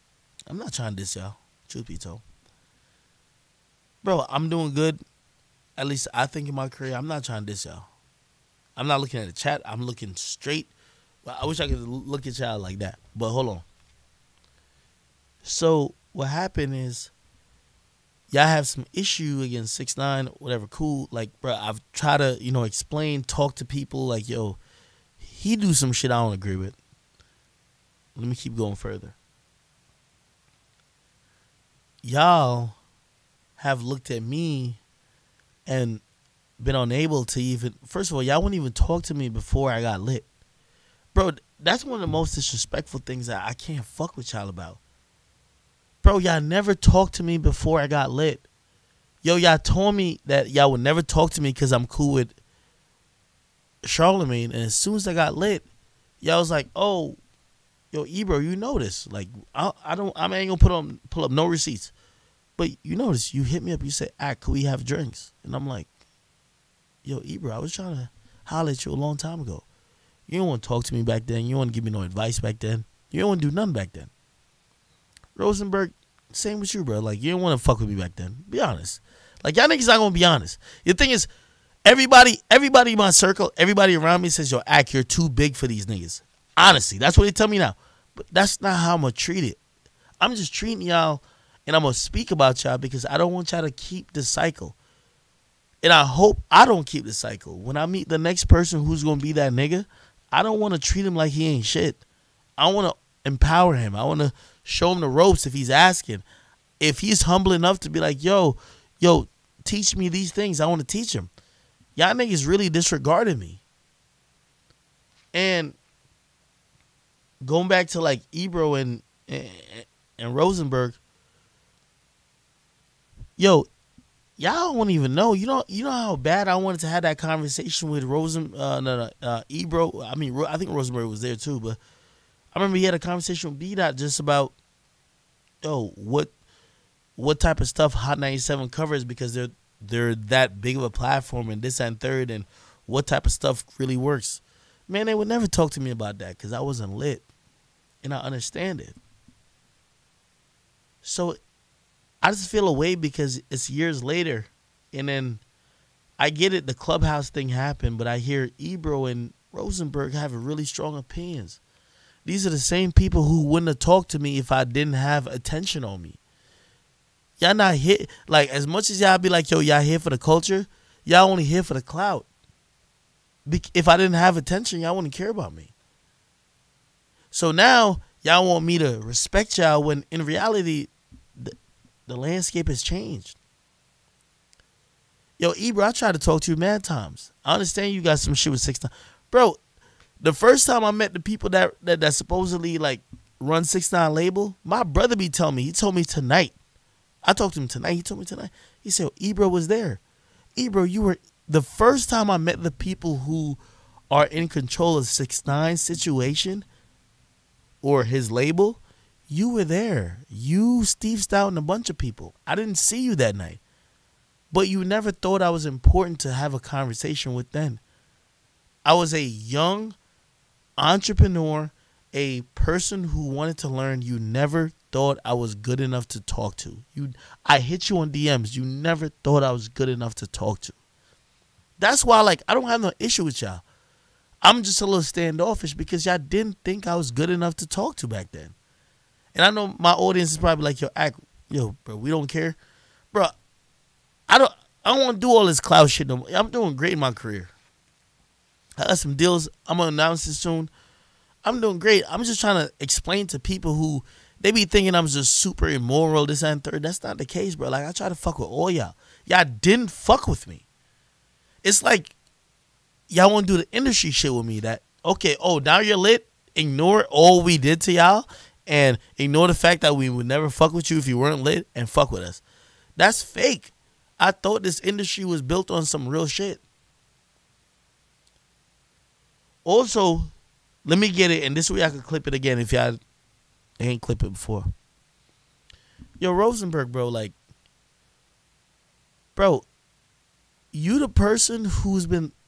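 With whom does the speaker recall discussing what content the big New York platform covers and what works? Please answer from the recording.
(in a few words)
B Dot.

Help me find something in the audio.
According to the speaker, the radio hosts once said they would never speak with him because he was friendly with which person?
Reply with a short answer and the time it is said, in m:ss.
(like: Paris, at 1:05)
Charlemagne, at 0:53.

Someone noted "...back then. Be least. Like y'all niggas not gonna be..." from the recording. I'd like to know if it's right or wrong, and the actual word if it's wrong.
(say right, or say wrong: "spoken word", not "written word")
wrong: "honest", not "least".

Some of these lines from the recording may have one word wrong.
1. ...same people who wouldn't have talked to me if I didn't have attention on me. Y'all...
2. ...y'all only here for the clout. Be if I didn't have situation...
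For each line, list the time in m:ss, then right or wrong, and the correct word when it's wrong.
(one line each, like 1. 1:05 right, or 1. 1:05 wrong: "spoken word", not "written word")
1. 2:42 right
2. 2:51 wrong: "attention", not "situation".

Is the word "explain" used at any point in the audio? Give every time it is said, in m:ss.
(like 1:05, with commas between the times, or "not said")
0:22, 4:12.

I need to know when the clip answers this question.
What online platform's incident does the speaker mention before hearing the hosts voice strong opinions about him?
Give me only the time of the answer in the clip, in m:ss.
2:36.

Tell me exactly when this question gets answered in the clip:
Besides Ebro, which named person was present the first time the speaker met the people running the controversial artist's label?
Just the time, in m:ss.
3:30.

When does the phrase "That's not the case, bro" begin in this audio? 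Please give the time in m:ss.
4:16.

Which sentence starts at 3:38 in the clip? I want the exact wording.
I was a young entrepreneur, a person who wanted to learn.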